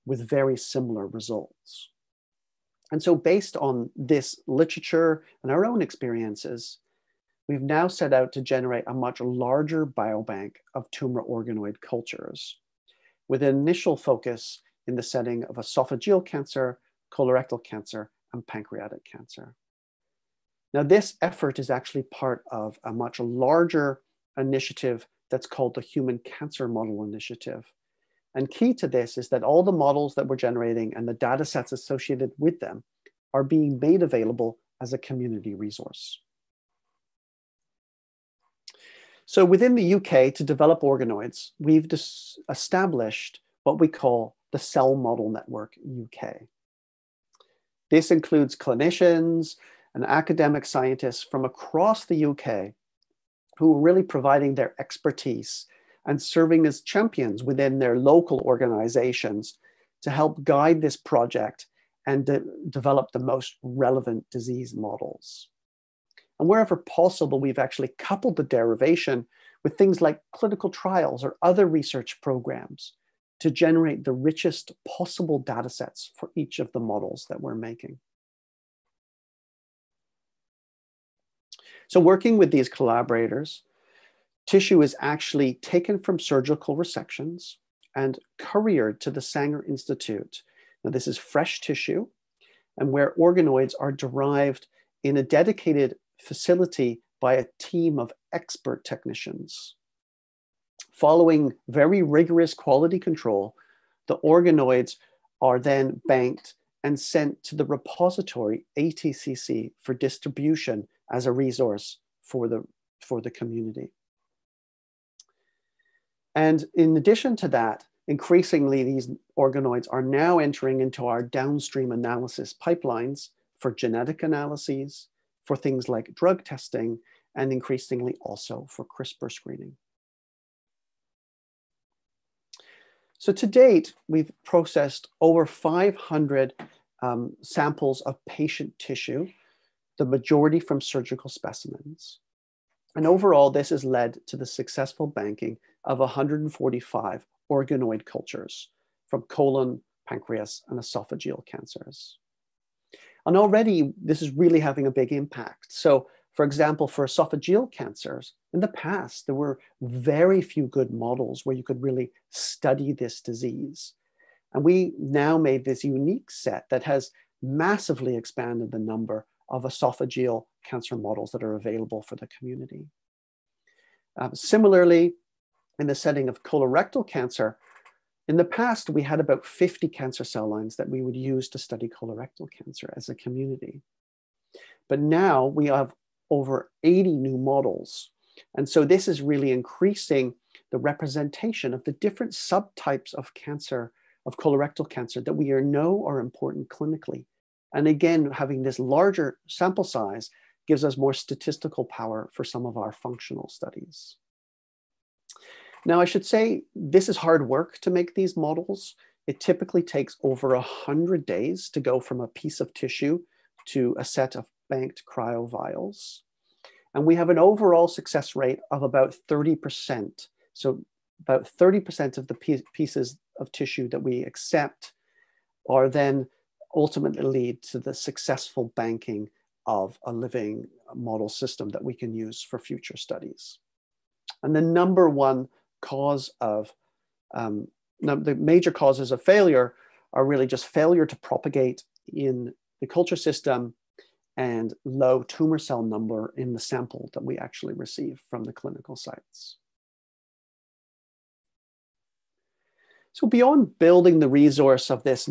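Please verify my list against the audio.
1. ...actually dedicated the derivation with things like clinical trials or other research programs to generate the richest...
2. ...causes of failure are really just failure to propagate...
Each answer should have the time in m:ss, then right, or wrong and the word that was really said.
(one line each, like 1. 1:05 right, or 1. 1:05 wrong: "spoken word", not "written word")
1. 1:07 wrong: "coupled", not "dedicated"
2. 3:58 right.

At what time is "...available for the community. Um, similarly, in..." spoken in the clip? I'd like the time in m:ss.
2:51.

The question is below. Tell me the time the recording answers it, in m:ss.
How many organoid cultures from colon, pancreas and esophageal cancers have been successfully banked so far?
2:25.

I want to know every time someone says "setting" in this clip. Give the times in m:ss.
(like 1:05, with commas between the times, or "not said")
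0:15, 2:55.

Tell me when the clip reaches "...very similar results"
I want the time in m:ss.
0:00.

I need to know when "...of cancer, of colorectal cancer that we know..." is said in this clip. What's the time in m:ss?
3:13.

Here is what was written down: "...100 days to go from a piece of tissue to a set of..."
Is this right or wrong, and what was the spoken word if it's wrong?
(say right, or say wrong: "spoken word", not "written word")
right.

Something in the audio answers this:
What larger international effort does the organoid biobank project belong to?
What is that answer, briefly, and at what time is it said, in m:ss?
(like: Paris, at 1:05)
Human Cancer Model Initiative, at 0:25.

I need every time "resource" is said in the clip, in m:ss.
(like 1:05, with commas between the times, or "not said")
0:35, 1:51, 4:14.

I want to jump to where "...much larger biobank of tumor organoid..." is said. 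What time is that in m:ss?
0:08.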